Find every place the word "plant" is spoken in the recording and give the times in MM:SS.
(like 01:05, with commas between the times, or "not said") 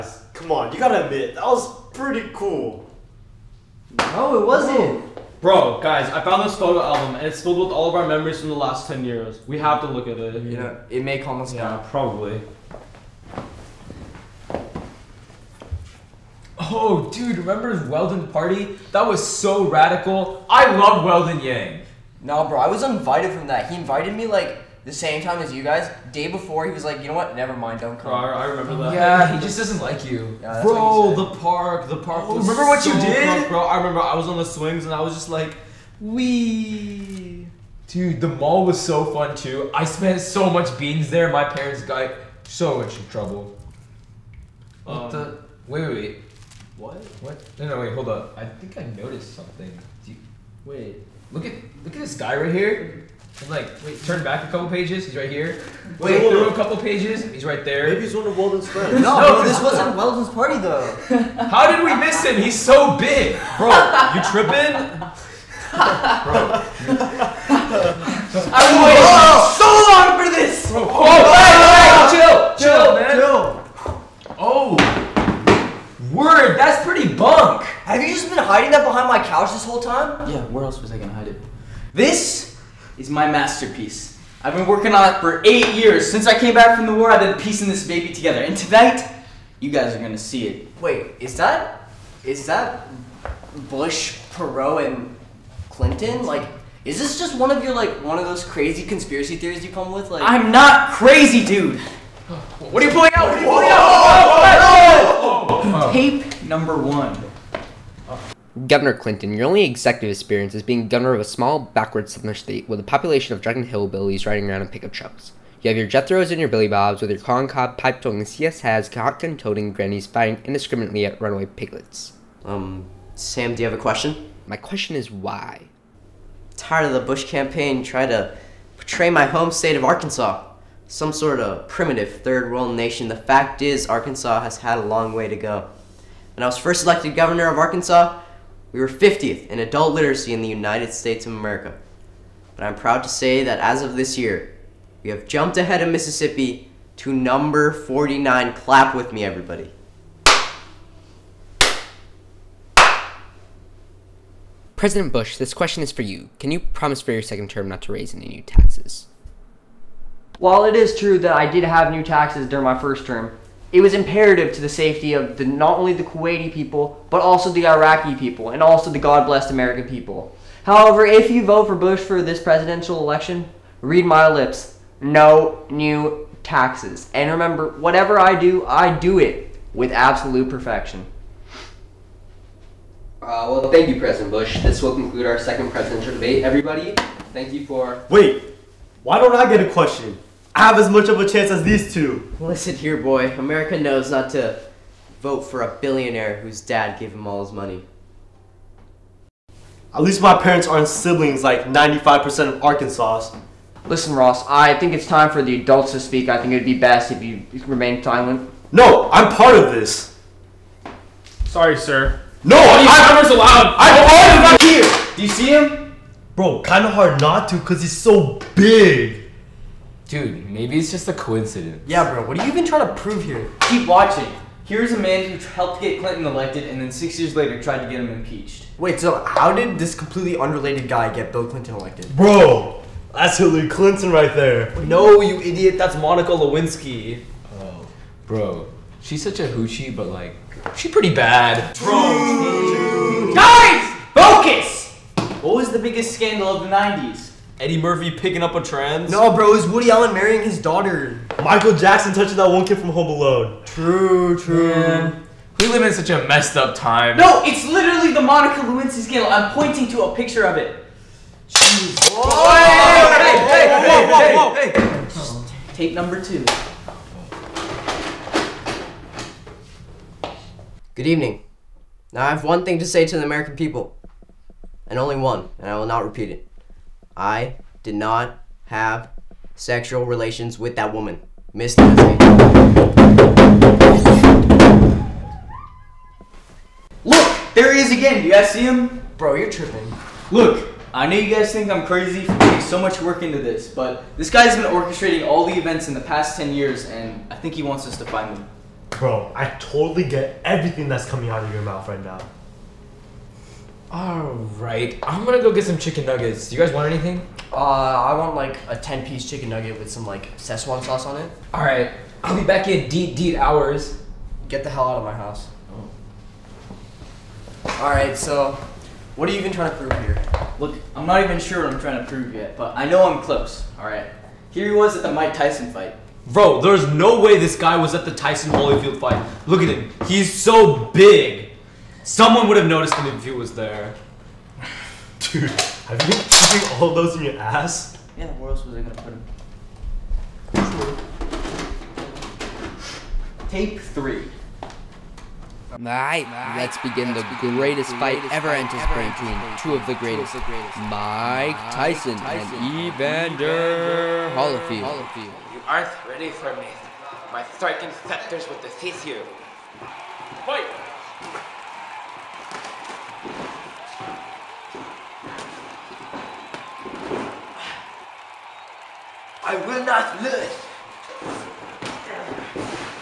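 not said.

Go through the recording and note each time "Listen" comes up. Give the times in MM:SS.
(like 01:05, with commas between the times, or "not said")
03:12, 03:23.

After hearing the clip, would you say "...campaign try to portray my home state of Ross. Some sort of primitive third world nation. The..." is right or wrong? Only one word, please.
wrong.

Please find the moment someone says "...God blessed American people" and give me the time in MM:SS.
02:48.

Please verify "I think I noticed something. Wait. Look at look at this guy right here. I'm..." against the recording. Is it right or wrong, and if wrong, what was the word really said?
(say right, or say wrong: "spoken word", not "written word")
right.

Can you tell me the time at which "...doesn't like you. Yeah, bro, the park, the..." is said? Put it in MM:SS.
00:29.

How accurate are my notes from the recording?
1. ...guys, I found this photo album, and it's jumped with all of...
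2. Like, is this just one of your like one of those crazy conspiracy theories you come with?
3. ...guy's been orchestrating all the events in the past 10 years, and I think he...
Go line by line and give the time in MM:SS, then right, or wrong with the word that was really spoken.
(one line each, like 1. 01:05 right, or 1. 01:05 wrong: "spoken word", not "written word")
1. 00:05 wrong: "filled", not "jumped"
2. 01:36 right
3. 04:54 right.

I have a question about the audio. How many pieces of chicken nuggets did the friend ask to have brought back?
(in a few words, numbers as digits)
10.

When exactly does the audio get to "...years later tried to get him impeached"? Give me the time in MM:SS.
03:47.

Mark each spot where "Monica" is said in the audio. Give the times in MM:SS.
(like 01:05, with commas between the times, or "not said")
03:55, 04:18.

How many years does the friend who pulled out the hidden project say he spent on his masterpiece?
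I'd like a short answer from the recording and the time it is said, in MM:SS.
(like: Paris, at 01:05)
8, at 01:25.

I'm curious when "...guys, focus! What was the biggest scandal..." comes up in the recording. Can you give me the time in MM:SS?
04:03.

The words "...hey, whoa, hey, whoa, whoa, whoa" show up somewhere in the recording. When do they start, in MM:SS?
04:23.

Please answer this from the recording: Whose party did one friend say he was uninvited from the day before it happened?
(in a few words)
Weldon Yang.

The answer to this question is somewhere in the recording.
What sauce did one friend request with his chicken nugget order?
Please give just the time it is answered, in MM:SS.
05:10.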